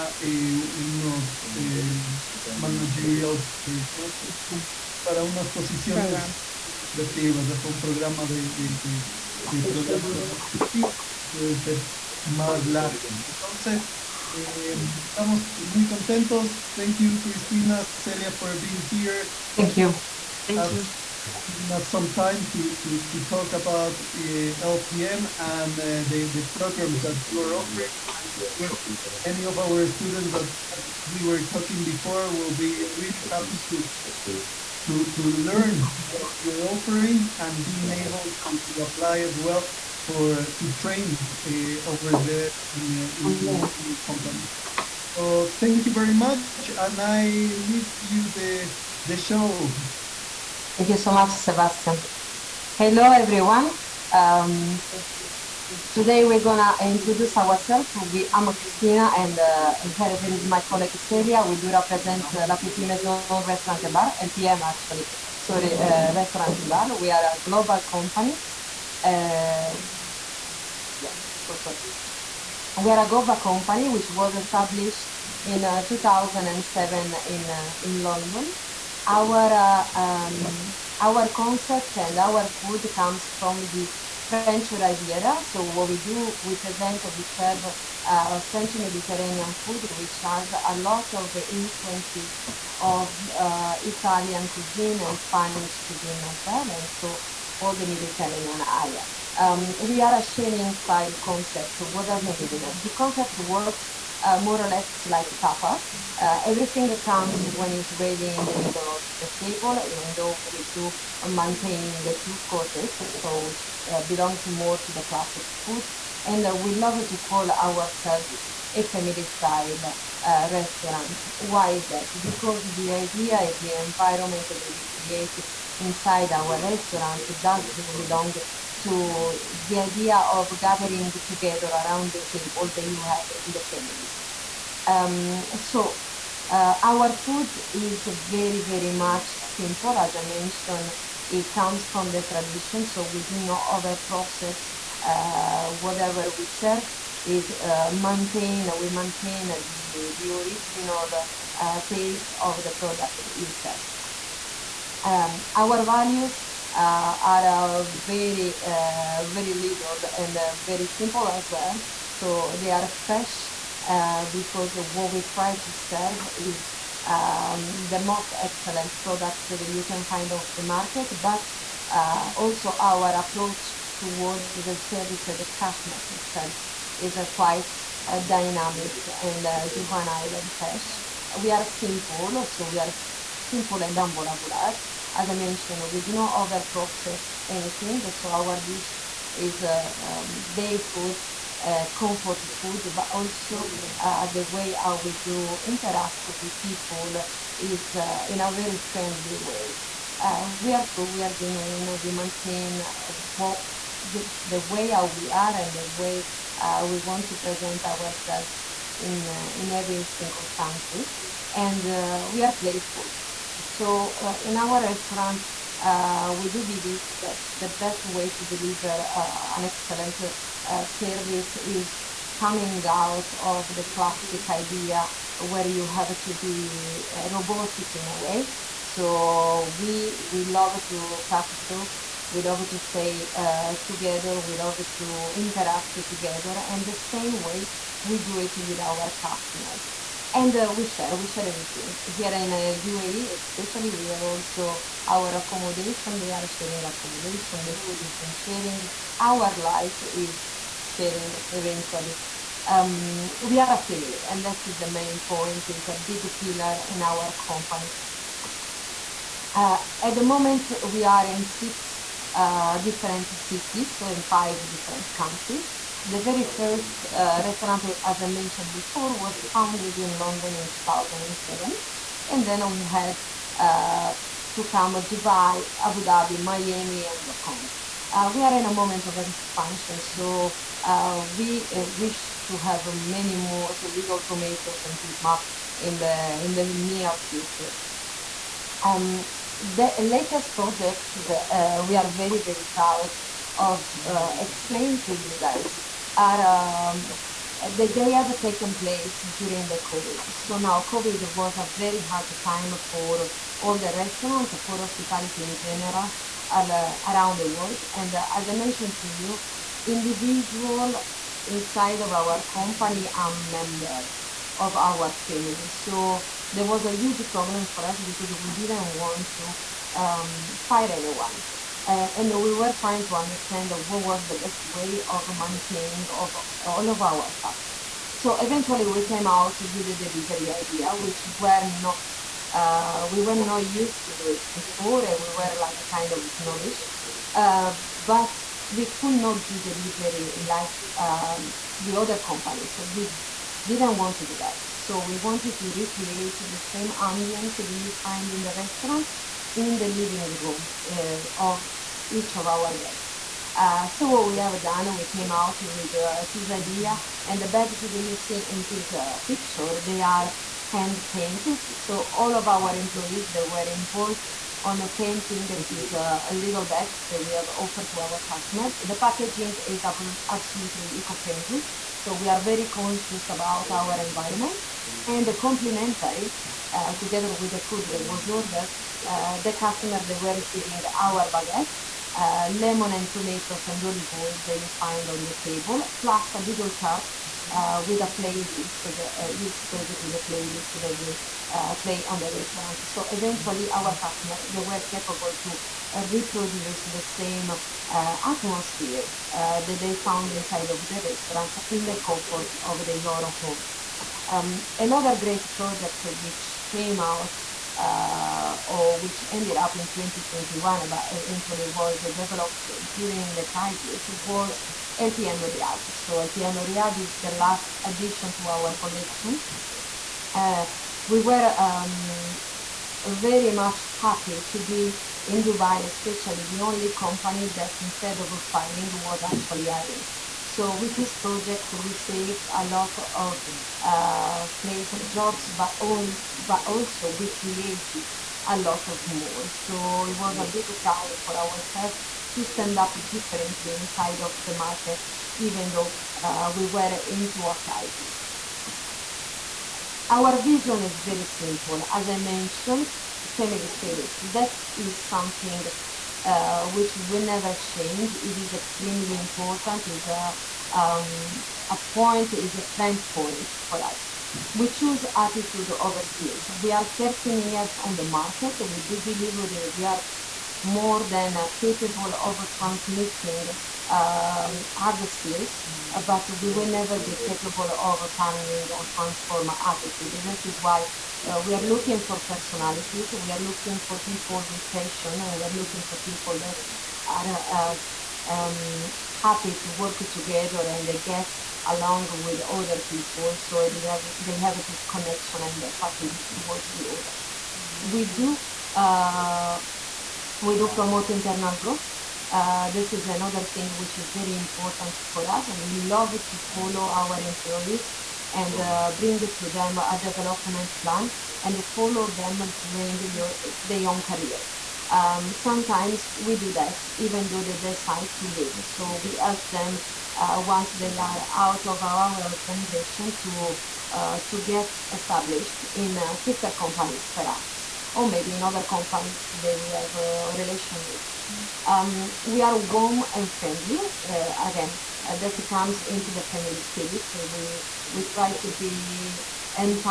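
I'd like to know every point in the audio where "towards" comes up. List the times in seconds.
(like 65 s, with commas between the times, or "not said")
173 s, 496 s.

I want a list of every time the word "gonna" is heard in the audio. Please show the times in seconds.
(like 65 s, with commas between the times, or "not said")
56 s.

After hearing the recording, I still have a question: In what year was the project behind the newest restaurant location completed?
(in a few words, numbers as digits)
2021.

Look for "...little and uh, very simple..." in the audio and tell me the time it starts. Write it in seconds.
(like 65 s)
159 s.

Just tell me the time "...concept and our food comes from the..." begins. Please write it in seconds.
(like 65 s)
81 s.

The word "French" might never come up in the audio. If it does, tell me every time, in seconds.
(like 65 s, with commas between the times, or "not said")
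84 s, 88 s.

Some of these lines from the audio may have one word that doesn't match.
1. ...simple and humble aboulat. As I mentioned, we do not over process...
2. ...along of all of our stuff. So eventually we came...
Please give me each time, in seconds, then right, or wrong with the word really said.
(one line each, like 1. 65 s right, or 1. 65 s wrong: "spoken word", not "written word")
1. 183 s right
2. 325 s wrong: "maintaining", not "along".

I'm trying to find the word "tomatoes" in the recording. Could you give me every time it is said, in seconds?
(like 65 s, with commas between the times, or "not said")
284 s, 383 s.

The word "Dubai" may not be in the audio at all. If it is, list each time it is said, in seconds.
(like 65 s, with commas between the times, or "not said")
275 s, 425 s.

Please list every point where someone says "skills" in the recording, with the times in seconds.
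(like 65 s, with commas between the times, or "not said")
466 s, 475 s.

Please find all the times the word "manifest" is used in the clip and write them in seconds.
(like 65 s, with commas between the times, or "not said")
not said.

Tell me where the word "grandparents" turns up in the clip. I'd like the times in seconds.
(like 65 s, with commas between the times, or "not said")
not said.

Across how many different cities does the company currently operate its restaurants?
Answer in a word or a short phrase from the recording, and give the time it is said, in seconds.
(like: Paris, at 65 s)
6, at 261 s.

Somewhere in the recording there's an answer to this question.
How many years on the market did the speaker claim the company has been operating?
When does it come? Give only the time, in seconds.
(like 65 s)
466 s.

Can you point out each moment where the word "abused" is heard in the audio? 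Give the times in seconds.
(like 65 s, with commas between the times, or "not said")
not said.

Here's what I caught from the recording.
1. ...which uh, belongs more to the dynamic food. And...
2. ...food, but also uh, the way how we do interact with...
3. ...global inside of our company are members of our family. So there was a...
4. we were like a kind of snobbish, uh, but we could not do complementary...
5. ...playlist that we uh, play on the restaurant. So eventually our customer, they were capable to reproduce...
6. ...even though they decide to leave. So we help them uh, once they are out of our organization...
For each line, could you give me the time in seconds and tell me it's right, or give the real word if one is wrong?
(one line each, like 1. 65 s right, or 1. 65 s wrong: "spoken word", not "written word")
1. 113 s wrong: "classic", not "dynamic"
2. 192 s right
3. 309 s wrong: "individual", not "global"
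4. 335 s wrong: "delivery", not "complementary"
5. 390 s right
6. 516 s right.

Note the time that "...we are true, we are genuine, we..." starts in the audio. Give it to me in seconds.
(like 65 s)
200 s.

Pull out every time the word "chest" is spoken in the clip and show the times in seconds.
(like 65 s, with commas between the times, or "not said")
not said.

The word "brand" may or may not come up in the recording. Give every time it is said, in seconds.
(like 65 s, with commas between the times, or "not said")
not said.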